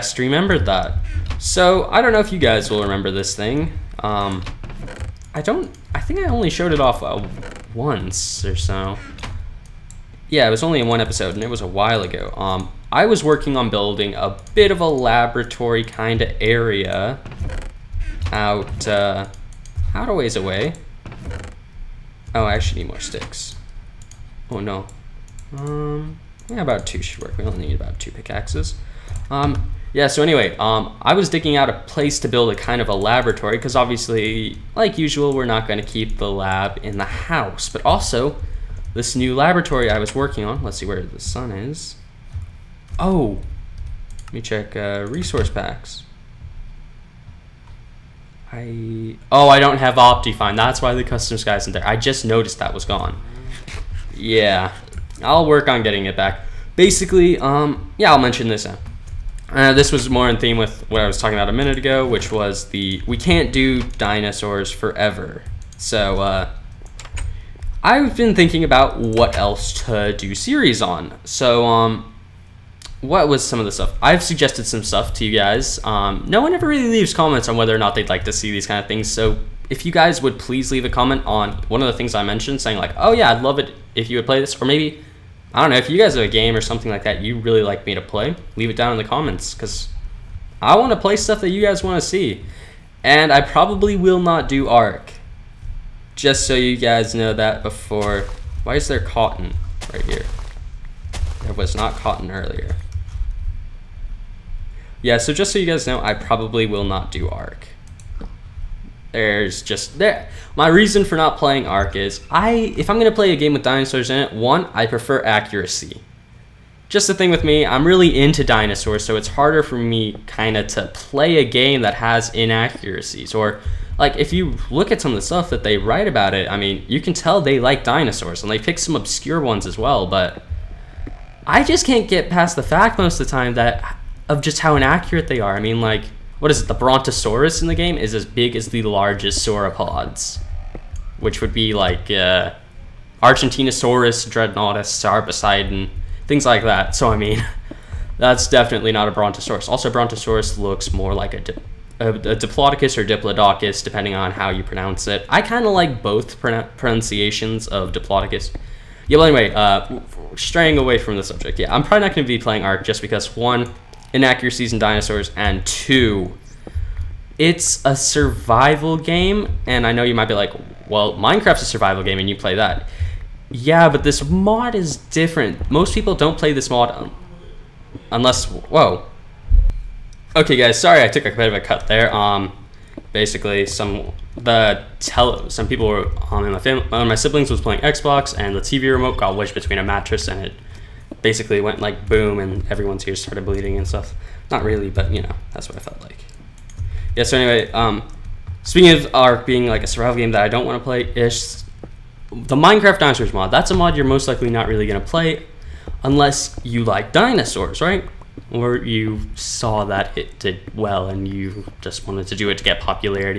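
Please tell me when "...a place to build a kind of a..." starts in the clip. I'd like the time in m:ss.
0:31.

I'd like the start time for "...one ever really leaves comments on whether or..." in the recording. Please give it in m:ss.
1:16.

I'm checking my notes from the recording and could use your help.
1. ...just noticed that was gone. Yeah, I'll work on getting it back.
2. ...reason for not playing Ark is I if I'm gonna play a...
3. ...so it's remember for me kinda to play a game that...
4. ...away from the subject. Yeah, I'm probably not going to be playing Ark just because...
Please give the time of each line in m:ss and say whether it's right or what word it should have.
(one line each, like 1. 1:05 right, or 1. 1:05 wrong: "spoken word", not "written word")
1. 0:51 right
2. 1:50 right
3. 1:59 wrong: "harder", not "remember"
4. 2:40 right.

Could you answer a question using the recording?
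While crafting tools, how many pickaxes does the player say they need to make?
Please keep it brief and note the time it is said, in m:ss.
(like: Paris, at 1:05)
2, at 0:27.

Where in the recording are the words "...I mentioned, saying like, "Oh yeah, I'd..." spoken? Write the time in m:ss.
1:22.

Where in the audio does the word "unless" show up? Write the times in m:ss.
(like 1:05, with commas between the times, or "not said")
2:58, 3:26.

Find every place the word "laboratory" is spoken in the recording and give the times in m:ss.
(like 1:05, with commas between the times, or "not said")
0:14, 0:32, 0:39.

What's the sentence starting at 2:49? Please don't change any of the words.
And I know you might be like, well, Minecraft's a survival game and you play that.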